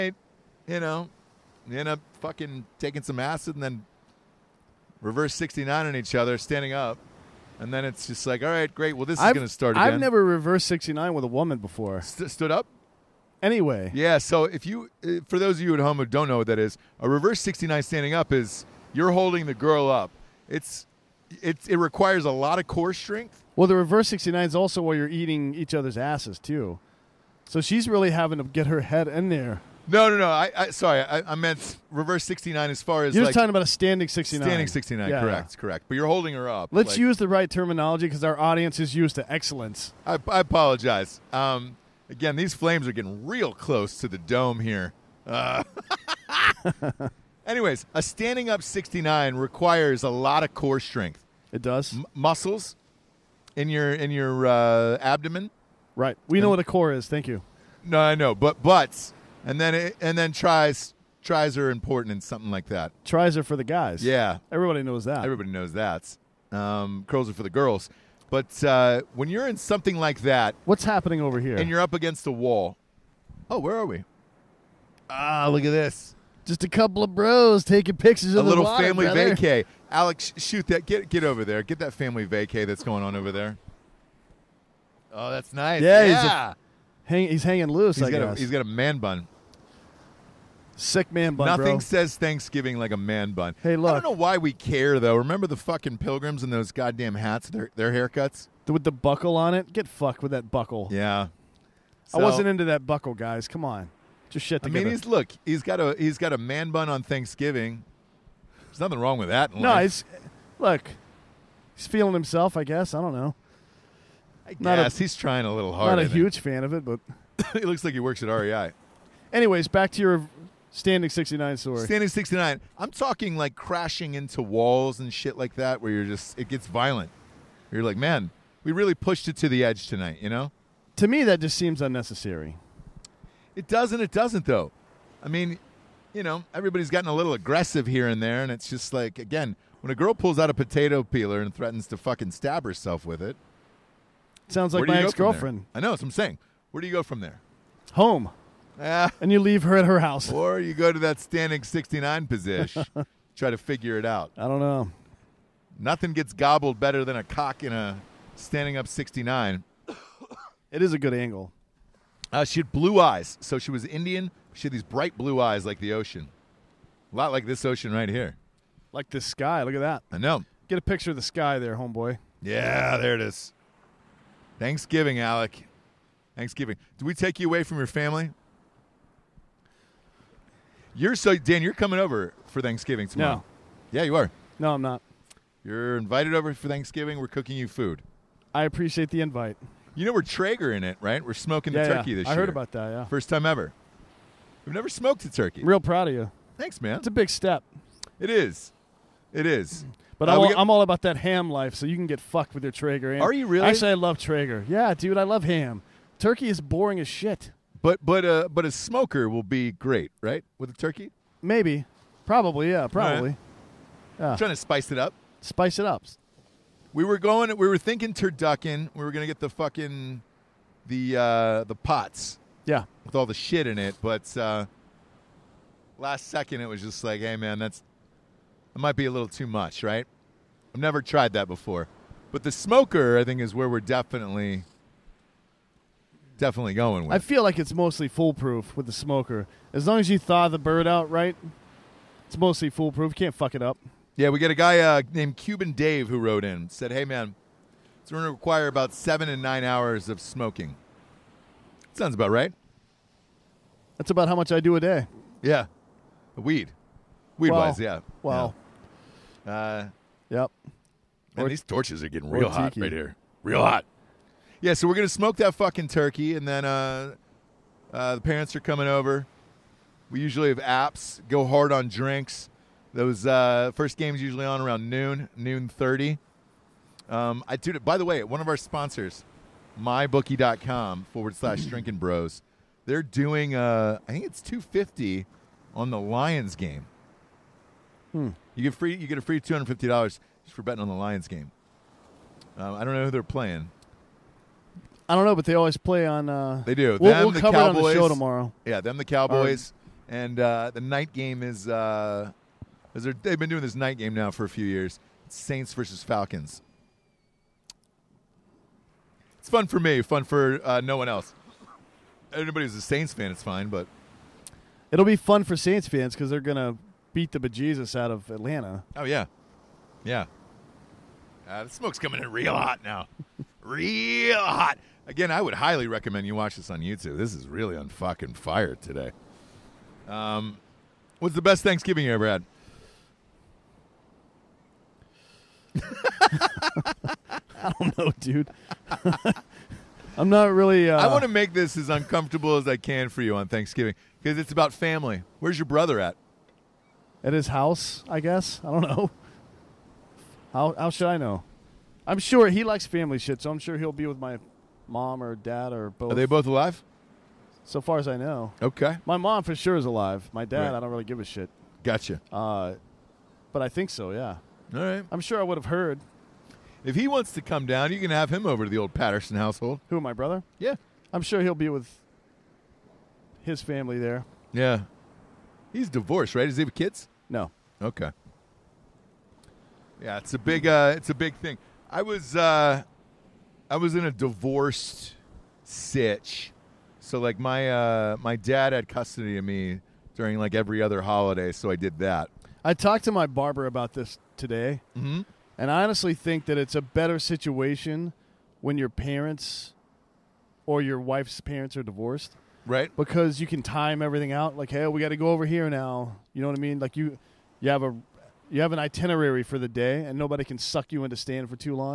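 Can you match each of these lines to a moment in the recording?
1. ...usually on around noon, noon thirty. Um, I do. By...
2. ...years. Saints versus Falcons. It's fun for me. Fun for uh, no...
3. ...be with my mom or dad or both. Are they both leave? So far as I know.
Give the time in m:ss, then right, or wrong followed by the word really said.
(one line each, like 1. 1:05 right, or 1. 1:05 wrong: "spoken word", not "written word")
1. 4:34 right
2. 5:04 right
3. 5:53 wrong: "alive", not "leave".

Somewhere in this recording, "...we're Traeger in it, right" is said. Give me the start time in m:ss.
3:10.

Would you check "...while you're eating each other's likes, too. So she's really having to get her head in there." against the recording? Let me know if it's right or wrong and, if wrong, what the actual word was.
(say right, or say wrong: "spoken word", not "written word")
wrong: "asses", not "likes".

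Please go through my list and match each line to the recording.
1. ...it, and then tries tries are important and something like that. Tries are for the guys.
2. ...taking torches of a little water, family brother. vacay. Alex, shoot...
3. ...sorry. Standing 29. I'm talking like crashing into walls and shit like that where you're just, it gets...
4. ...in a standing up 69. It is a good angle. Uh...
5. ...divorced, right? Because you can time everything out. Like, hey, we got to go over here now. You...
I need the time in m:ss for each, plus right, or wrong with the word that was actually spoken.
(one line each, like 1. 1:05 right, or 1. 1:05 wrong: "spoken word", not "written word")
1. 0:59 right
2. 1:17 wrong: "pictures", not "torches"
3. 2:01 wrong: "69", not "29"
4. 2:37 right
5. 6:41 right.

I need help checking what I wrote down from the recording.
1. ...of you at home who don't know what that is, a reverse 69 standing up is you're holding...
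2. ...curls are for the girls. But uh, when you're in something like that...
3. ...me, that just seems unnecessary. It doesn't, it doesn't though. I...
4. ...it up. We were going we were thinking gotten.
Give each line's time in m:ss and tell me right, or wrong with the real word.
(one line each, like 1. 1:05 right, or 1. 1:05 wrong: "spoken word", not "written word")
1. 0:15 right
2. 1:07 right
3. 2:11 right
4. 3:35 wrong: "turducken", not "gotten".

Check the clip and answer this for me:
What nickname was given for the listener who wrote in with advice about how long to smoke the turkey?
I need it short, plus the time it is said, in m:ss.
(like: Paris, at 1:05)
Cuban Dave, at 4:05.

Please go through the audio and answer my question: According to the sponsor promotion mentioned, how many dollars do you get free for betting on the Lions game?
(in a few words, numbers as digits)
$250.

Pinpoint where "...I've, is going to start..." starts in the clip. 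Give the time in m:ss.
0:09.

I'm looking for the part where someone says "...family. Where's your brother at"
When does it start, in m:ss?
5:44.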